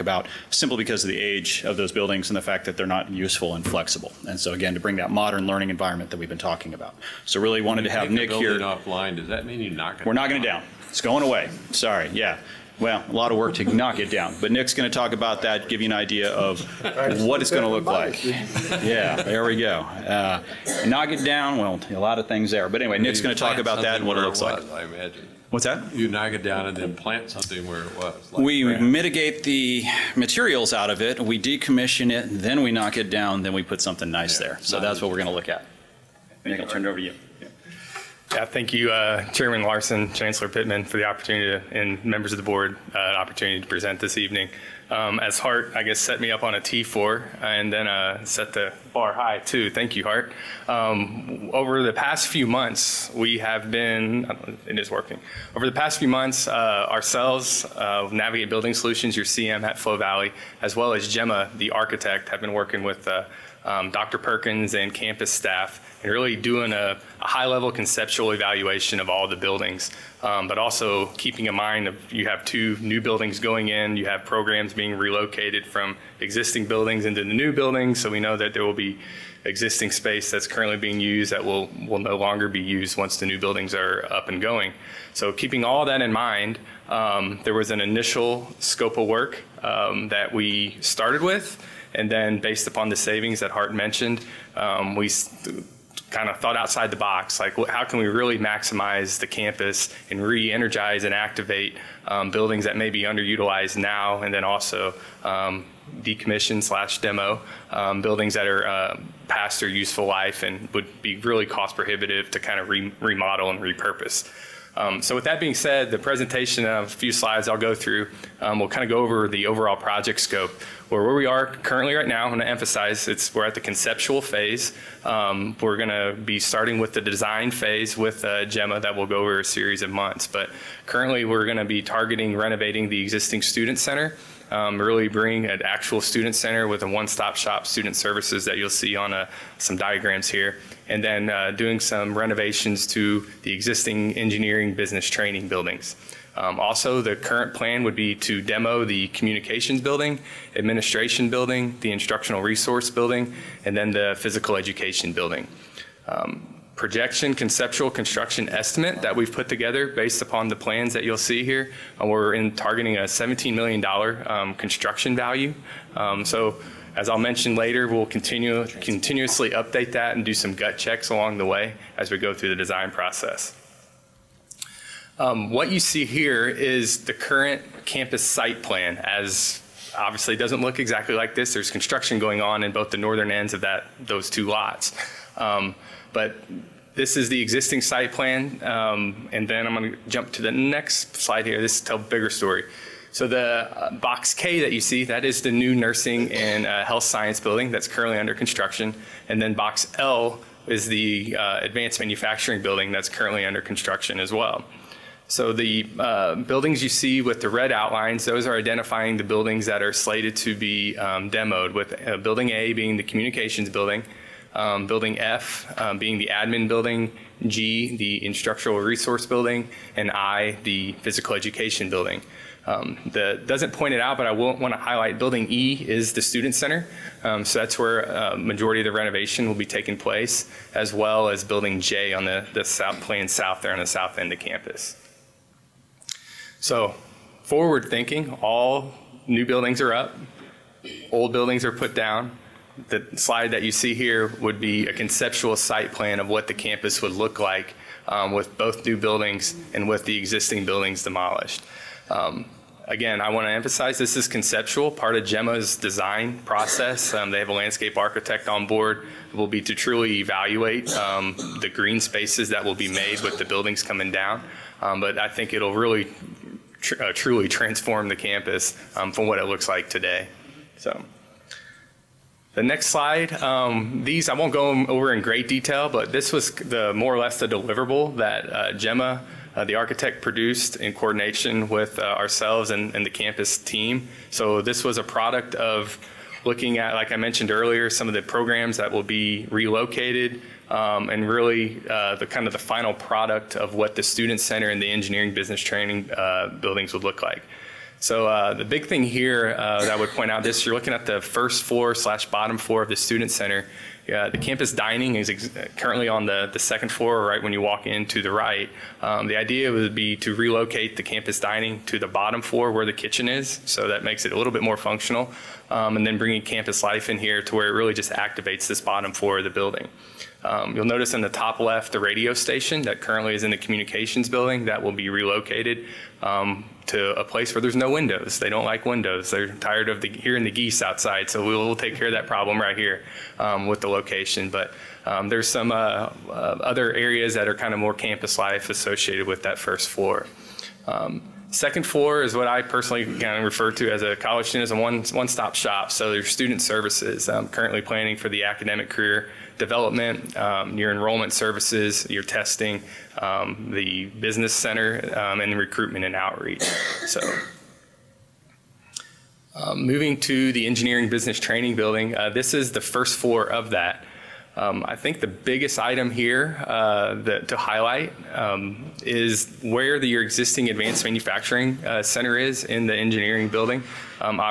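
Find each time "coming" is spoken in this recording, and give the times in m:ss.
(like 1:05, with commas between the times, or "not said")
4:23.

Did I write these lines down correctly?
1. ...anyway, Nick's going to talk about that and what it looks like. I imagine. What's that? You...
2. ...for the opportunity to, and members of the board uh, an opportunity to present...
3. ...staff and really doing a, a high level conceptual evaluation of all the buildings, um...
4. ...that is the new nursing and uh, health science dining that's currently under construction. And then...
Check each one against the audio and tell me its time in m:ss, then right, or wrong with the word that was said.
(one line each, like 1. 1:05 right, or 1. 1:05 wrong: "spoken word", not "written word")
1. 0:22 right
2. 0:40 right
3. 1:05 right
4. 3:15 wrong: "building", not "dining".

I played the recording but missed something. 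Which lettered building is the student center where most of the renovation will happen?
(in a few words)
Building E.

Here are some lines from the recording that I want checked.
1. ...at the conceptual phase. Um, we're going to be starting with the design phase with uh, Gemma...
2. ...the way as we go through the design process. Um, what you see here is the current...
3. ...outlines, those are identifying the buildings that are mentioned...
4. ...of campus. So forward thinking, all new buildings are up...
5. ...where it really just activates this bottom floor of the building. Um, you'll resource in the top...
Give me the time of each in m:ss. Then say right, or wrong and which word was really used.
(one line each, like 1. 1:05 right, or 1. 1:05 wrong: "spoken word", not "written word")
1. 2:03 right
2. 2:51 right
3. 3:27 wrong: "slated", not "mentioned"
4. 3:54 right
5. 5:17 wrong: "notice", not "resource".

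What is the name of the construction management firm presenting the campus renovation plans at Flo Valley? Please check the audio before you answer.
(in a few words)
Navigate Building Solutions.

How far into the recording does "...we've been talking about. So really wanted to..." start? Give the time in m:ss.
0:06.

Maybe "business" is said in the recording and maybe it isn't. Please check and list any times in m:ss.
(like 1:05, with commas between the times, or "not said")
2:24, 4:55, 5:54, 6:01.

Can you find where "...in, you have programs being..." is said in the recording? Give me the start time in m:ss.
1:13.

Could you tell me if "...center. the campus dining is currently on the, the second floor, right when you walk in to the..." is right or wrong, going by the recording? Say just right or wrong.
right.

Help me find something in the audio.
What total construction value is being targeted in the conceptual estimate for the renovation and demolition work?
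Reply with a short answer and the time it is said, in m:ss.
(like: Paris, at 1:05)
$17 million, at 2:43.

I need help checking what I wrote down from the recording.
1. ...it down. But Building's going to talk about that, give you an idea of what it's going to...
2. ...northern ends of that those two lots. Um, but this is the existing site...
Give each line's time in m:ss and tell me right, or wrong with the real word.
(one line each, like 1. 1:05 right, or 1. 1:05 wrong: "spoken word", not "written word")
1. 0:13 wrong: "Nick", not "Building"
2. 3:02 right.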